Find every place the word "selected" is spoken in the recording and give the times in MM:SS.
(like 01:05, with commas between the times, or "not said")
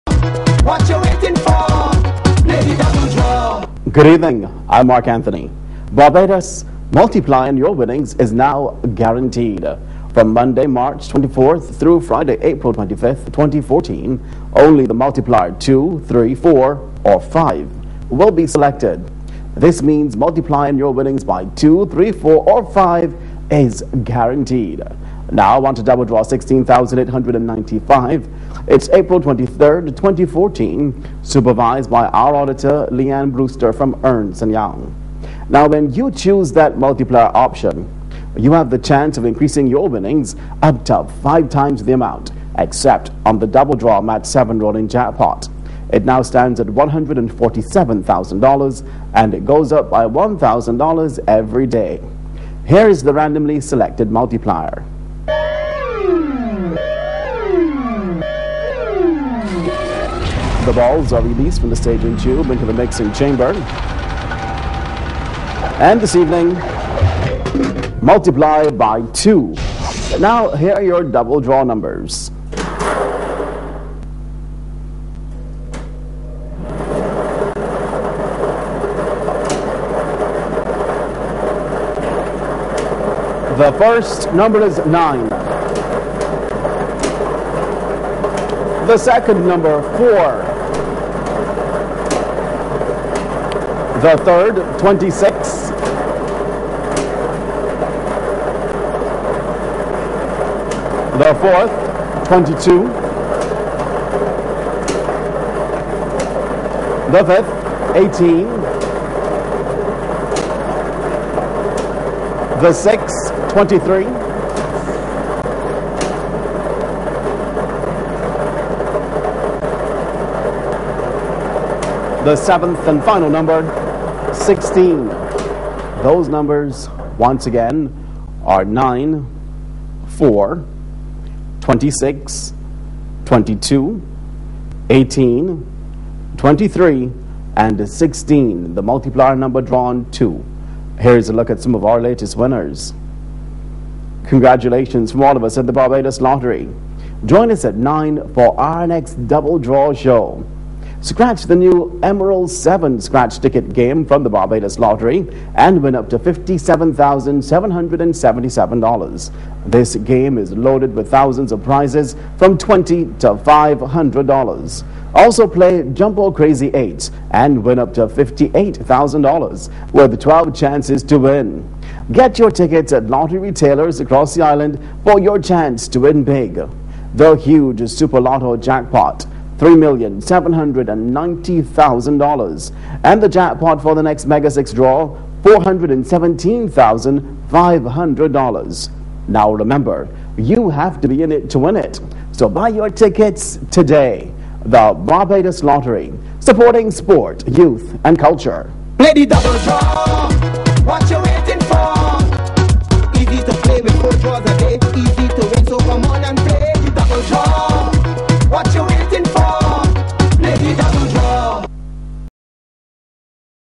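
00:18, 00:53.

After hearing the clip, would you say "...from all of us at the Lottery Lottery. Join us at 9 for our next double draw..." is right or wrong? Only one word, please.
wrong.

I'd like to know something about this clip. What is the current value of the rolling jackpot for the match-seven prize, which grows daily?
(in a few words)
$147,000.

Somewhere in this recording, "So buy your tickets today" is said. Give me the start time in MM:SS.
03:12.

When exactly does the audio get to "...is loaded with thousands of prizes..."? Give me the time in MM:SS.
02:40.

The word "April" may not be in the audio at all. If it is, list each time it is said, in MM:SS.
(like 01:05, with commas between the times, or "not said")
00:12, 00:28.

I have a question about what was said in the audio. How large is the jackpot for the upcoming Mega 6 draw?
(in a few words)
$417,500.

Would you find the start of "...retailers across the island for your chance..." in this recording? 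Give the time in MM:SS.
02:53.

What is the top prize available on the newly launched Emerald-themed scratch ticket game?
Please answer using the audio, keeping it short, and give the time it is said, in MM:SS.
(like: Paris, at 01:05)
$57,777, at 02:36.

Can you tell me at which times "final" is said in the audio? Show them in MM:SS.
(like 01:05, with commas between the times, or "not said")
02:03.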